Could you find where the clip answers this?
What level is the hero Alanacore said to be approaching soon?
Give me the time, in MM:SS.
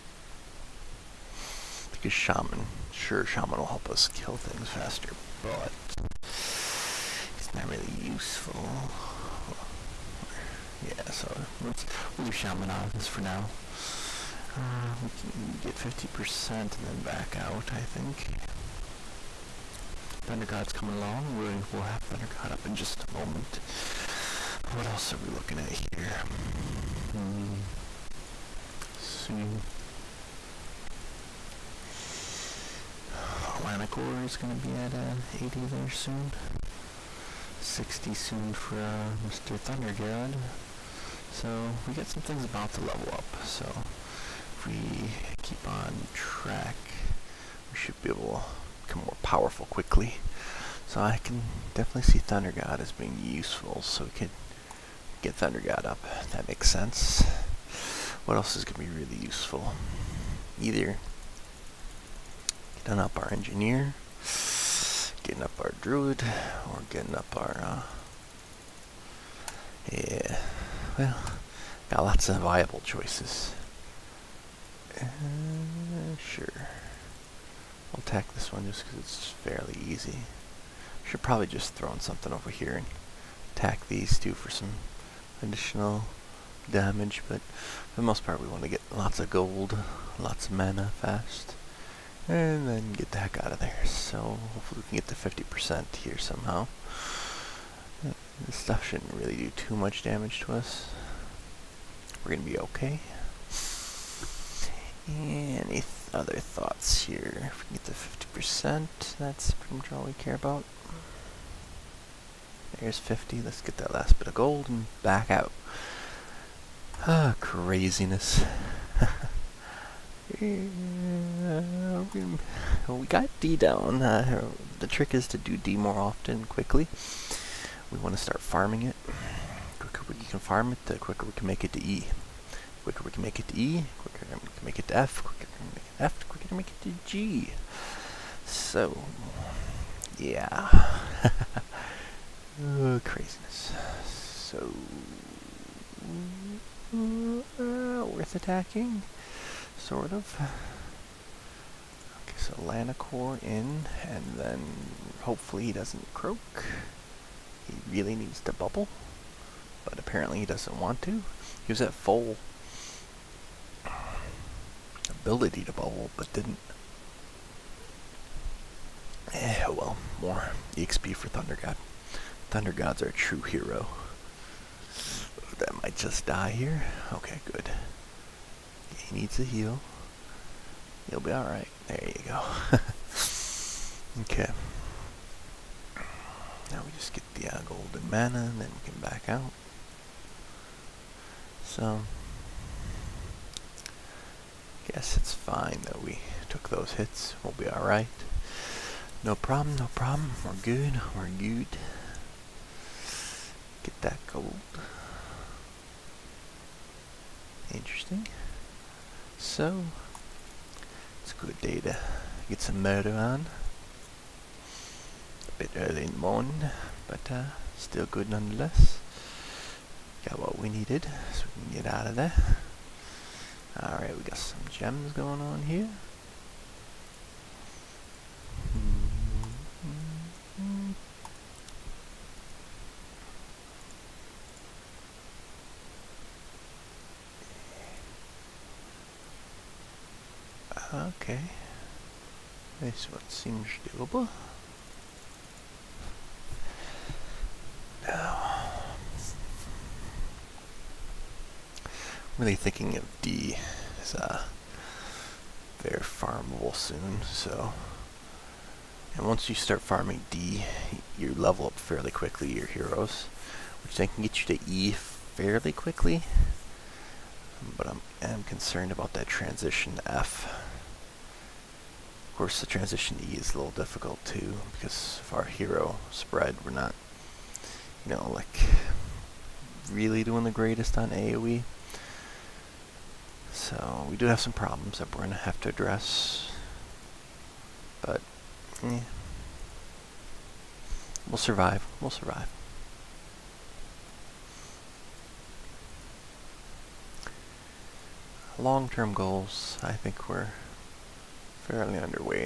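00:35.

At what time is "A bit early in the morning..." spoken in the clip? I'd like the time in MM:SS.
03:35.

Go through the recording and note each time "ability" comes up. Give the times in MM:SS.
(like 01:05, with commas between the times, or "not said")
02:45.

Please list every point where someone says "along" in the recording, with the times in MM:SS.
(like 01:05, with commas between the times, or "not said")
00:20.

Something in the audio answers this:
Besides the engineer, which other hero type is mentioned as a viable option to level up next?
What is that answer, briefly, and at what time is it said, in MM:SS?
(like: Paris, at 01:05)
druid, at 01:05.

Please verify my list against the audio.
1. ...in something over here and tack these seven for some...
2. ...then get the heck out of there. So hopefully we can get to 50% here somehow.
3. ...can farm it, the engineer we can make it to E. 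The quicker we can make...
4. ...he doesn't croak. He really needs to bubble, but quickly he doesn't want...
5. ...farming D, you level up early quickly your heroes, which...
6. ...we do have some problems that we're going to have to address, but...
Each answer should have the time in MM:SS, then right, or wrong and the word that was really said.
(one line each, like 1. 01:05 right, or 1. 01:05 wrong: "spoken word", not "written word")
1. 01:21 wrong: "two", not "seven"
2. 01:32 right
3. 02:10 wrong: "quicker", not "engineer"
4. 02:35 wrong: "apparently", not "quickly"
5. 04:19 wrong: "fairly", not "early"
6. 04:44 right.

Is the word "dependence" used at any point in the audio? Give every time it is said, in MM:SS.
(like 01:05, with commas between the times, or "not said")
not said.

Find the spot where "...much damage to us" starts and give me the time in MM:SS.
01:39.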